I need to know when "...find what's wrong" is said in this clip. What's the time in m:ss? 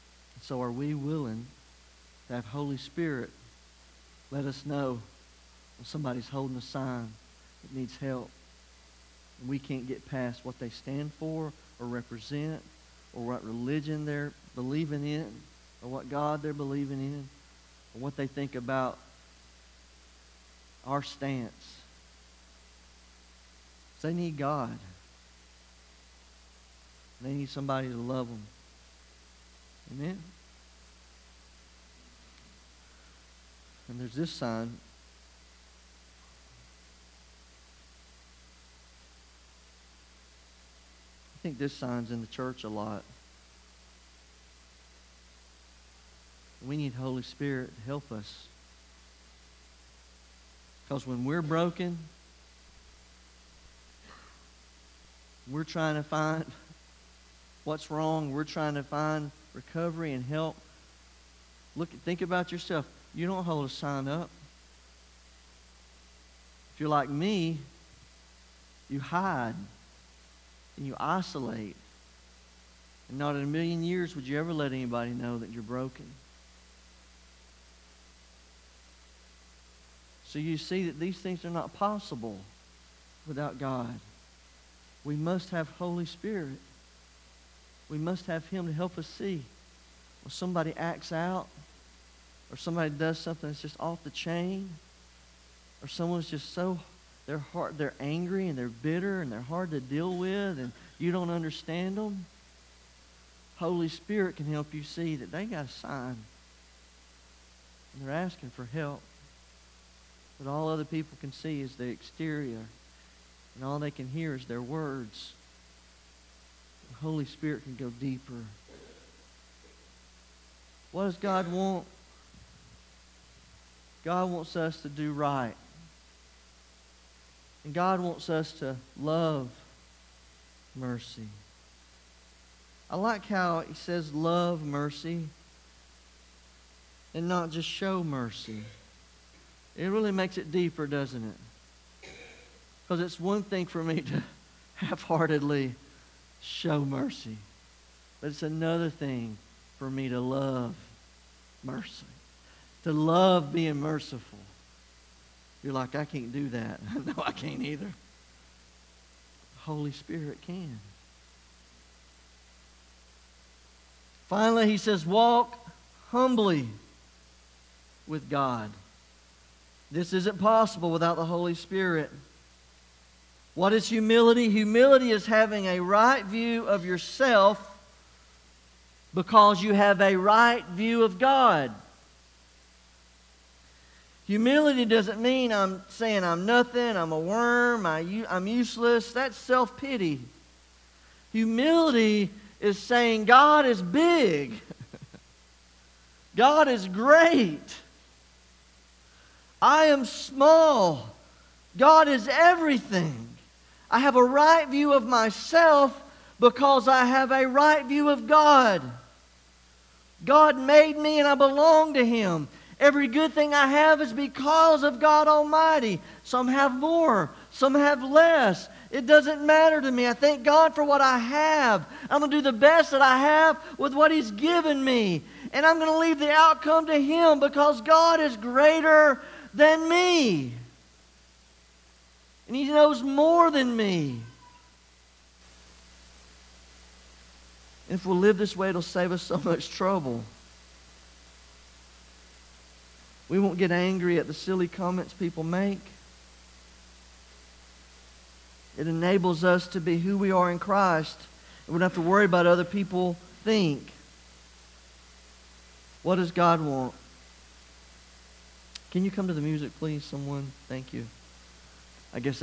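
0:56.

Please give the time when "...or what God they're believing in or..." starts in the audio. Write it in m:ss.
0:15.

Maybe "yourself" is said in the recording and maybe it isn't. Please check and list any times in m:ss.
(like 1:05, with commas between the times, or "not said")
1:02, 2:56.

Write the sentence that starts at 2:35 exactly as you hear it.
You're like, I can't do that.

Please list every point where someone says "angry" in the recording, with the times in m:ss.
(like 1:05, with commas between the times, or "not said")
1:38, 4:03.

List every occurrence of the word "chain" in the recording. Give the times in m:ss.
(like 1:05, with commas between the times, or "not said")
1:34.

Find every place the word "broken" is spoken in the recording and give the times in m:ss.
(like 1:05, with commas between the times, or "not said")
0:51, 1:15.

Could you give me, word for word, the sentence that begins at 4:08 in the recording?
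It enables us to be who we are in Christ.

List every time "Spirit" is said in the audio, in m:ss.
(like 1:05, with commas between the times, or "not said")
0:02, 0:47, 1:26, 1:43, 1:57, 2:39, 2:51.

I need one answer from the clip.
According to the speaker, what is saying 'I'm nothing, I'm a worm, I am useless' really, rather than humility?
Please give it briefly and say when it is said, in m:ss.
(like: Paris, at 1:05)
self pity, at 3:09.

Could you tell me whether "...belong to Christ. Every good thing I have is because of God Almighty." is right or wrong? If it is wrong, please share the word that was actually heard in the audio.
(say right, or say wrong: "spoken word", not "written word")
wrong: "Him", not "Christ".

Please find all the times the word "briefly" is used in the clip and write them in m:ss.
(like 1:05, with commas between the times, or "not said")
not said.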